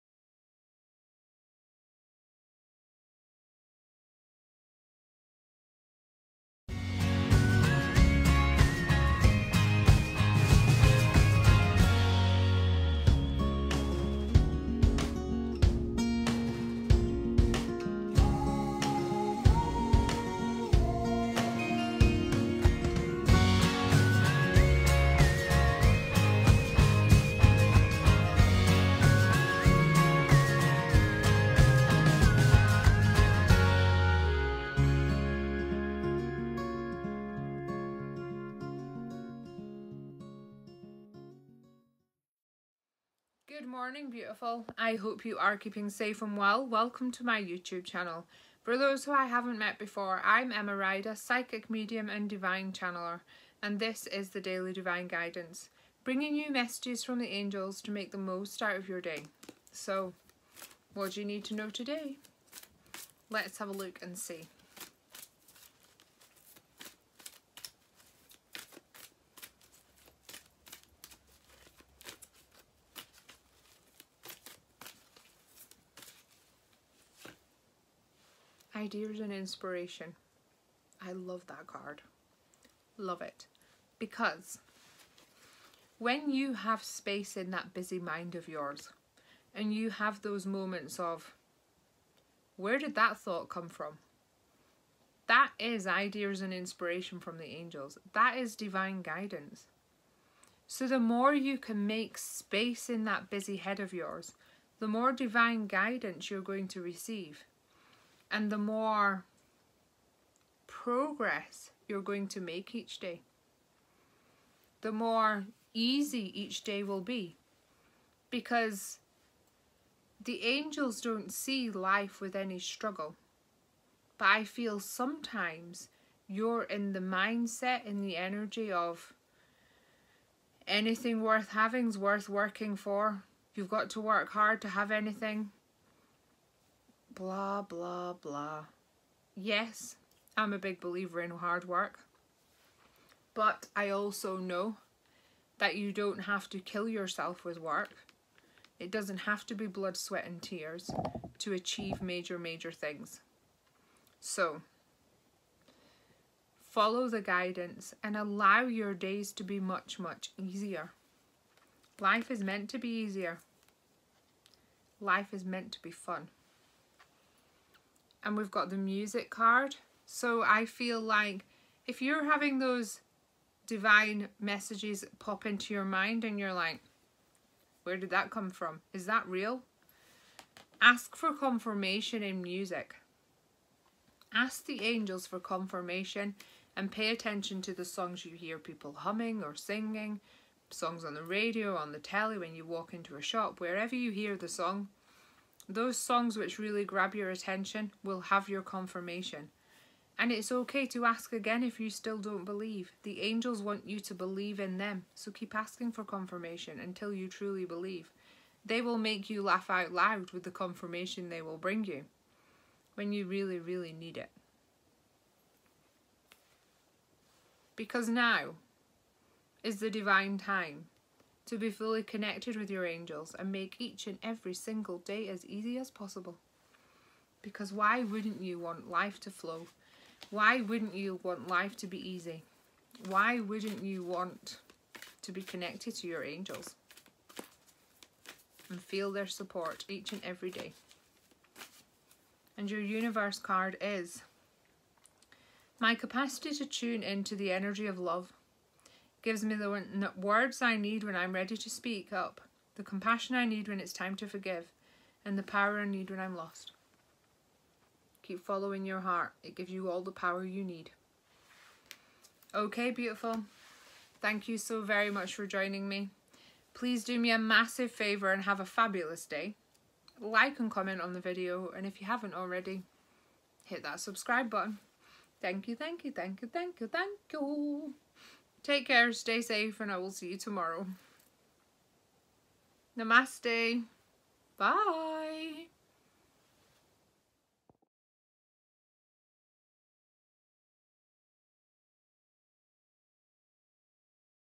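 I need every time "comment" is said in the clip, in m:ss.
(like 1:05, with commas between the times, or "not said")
4:30.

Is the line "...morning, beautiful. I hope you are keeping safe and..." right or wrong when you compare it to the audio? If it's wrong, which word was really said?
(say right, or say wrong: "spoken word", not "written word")
right.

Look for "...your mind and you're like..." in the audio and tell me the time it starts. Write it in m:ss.
2:55.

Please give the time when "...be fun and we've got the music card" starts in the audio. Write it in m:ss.
2:45.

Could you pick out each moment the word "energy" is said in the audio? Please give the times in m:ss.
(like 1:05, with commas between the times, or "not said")
2:08, 4:07.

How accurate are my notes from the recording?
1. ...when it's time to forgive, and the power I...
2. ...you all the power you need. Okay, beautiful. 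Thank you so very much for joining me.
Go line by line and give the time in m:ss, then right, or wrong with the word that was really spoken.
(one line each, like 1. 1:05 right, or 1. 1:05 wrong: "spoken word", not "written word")
1. 4:13 right
2. 4:19 right.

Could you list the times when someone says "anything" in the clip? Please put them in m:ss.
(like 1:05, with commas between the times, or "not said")
2:10, 2:14.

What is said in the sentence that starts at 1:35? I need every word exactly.
That is ideas and inspiration from the angels.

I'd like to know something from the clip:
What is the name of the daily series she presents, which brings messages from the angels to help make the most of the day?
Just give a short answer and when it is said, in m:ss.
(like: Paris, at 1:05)
Daily Divine Guidance, at 0:54.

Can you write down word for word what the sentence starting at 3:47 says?
Because why wouldn't you want life to flow?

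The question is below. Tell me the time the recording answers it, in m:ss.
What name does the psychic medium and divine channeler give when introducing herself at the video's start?
0:50.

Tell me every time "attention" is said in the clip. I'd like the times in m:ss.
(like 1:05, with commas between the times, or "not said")
3:07, 3:17.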